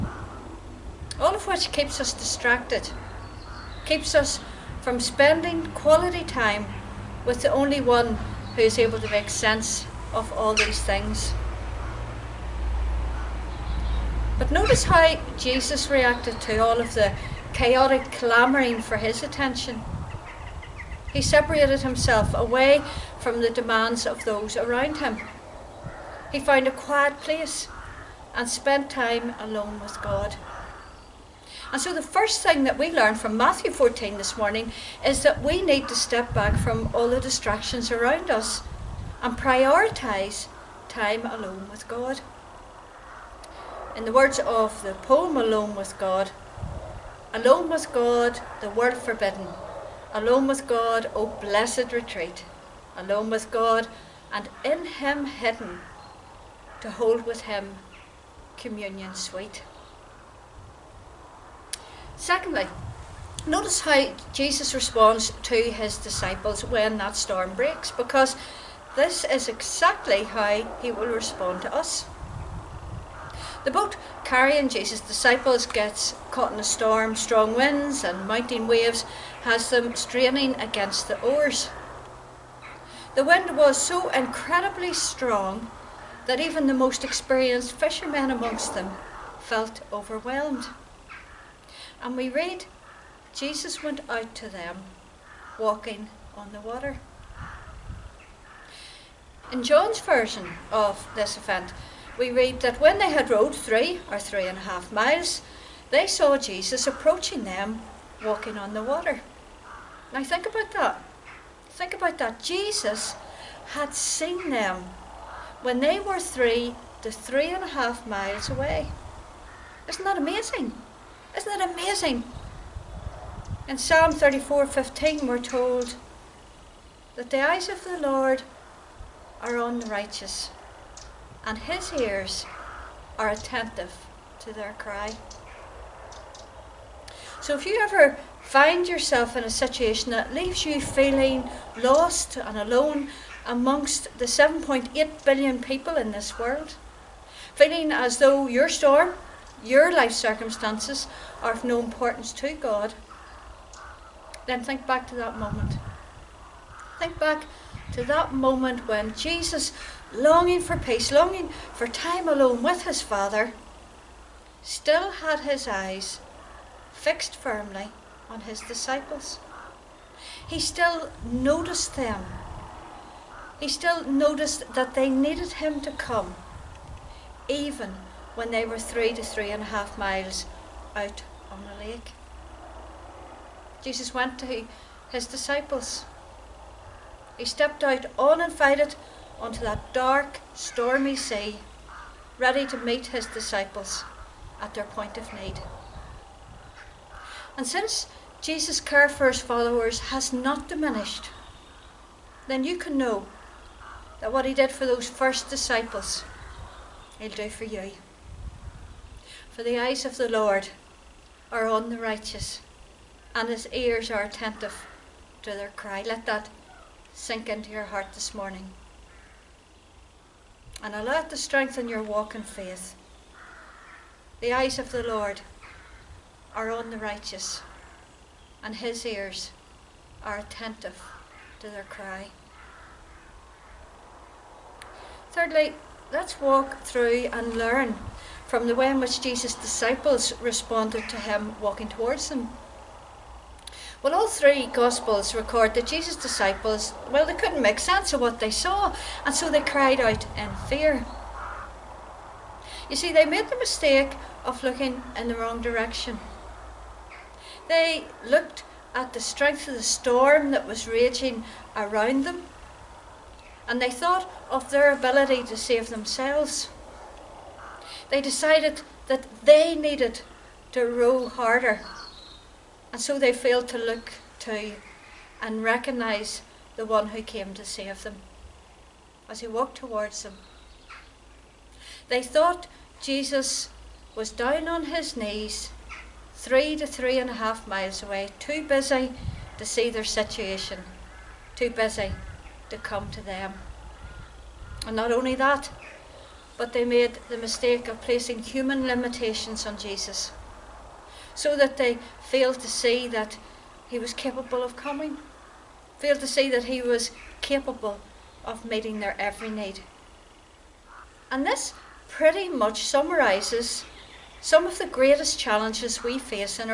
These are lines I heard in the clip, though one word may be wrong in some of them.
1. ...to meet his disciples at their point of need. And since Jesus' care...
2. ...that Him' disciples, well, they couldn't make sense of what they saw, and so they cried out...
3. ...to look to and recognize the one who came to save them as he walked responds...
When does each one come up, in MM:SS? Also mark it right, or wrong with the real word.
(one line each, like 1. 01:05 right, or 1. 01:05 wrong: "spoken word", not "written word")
1. 03:12 right
2. 04:05 wrong: "Jesus", not "Him"
3. 04:33 wrong: "towards", not "responds".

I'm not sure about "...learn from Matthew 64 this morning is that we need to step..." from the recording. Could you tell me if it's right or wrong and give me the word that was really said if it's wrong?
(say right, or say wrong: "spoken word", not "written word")
wrong: "14", not "64".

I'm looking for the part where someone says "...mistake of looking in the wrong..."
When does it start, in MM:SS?
04:13.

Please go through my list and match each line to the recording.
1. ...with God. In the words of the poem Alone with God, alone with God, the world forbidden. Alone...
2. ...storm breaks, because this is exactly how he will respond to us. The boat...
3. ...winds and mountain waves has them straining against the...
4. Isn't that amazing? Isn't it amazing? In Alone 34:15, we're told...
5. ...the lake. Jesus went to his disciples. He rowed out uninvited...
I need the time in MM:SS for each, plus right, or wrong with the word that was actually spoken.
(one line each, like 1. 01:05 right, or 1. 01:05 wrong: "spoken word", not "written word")
1. 00:41 right
2. 01:07 right
3. 01:17 right
4. 01:59 wrong: "Psalm", not "Alone"
5. 03:01 wrong: "stepped", not "rowed".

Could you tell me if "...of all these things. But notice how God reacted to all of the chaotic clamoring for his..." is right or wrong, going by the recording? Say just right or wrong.
wrong.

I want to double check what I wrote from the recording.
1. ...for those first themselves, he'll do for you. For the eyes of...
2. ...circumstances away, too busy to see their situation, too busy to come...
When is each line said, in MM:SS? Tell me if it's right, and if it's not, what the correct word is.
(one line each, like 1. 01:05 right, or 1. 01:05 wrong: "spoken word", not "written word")
1. 03:24 wrong: "disciples", not "themselves"
2. 04:47 wrong: "miles", not "circumstances".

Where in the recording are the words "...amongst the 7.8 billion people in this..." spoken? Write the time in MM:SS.
02:23.